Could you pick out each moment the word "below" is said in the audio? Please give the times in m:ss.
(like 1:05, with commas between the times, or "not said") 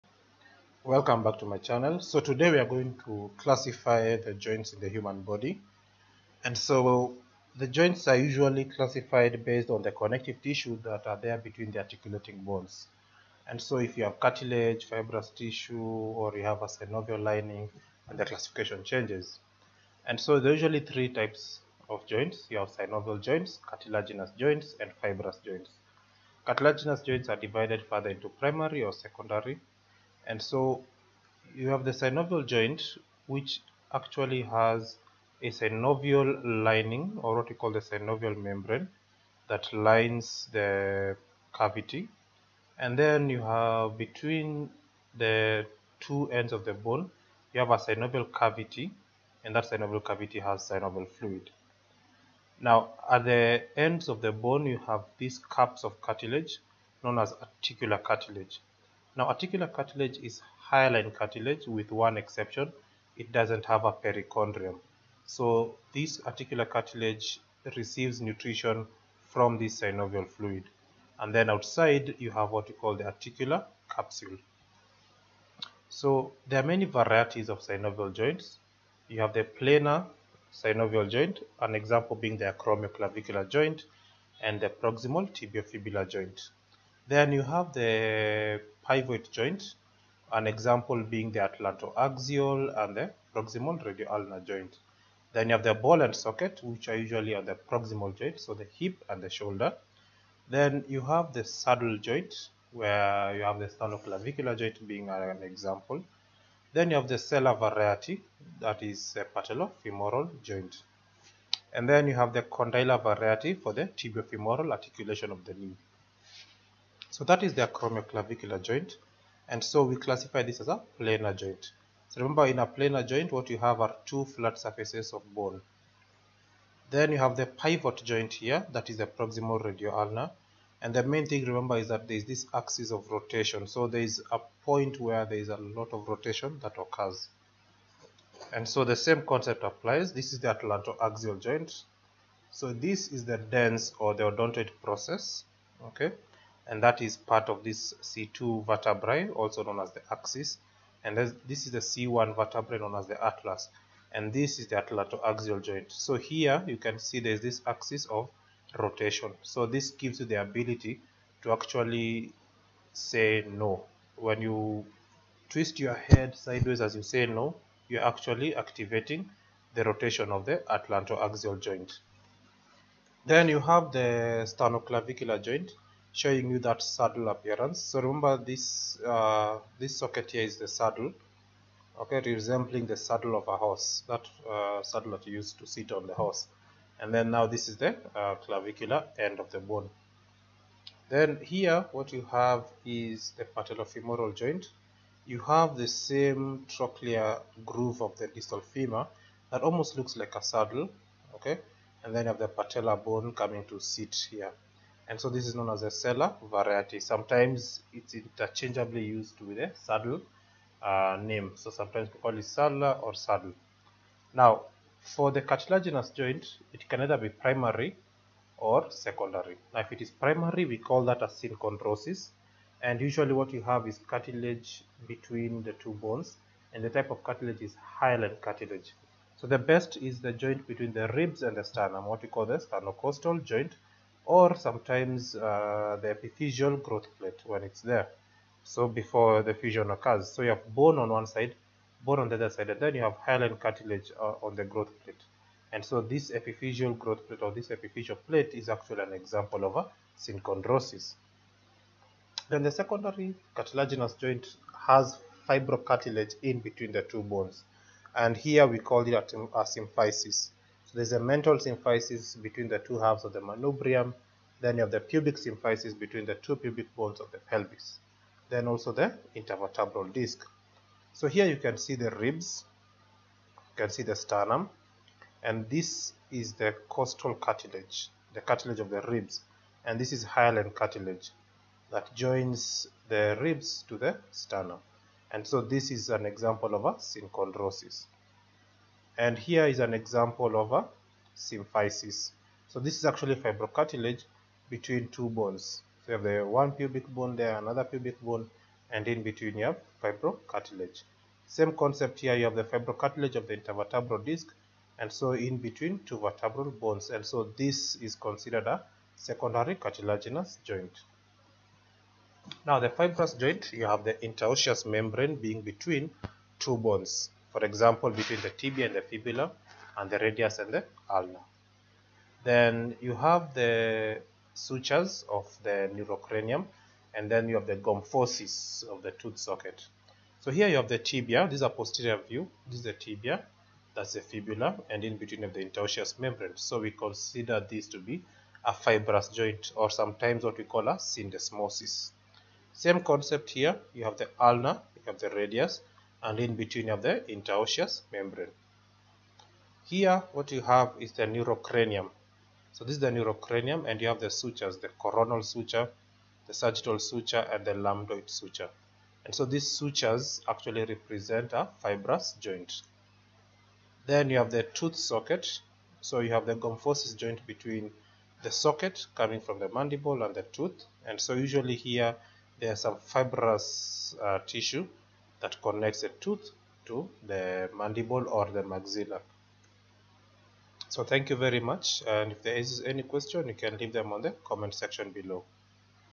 6:25.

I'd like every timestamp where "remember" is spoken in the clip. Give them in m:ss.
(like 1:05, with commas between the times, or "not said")
2:02, 2:11, 2:58.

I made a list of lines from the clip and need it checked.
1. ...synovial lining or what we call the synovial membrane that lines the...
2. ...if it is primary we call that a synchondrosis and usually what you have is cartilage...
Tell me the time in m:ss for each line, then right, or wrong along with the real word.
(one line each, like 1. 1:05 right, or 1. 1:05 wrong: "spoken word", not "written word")
1. 0:35 right
2. 3:39 right.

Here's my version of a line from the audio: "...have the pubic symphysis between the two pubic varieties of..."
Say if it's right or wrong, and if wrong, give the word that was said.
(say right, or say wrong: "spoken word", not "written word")
wrong: "bones", not "varieties".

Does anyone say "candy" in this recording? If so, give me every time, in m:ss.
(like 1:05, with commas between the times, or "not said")
not said.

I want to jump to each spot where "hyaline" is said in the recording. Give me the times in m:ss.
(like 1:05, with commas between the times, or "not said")
1:00, 3:47, 4:03, 4:40.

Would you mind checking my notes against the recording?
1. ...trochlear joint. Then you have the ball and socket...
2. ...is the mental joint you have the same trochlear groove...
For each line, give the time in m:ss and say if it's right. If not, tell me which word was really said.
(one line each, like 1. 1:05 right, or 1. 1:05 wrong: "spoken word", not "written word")
1. 1:33 wrong: "radioulnar", not "trochlear"
2. 3:12 wrong: "patellofemoral", not "mental".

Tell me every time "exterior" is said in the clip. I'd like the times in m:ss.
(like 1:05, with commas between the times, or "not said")
not said.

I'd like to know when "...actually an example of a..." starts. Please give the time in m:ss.
4:08.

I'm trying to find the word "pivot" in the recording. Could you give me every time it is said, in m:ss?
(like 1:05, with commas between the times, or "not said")
1:28, 2:07.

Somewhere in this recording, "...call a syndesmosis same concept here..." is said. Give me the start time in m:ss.
5:40.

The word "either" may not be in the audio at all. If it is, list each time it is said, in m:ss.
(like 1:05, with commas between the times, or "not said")
3:37.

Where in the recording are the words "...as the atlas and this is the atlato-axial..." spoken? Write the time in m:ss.
2:32.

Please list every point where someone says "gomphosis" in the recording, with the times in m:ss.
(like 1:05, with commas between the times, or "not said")
5:27, 6:06.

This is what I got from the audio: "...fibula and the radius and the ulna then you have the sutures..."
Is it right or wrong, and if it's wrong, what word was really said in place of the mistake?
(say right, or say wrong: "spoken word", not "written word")
right.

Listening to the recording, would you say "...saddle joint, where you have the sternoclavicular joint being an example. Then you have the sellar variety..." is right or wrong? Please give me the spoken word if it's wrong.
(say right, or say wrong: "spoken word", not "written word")
right.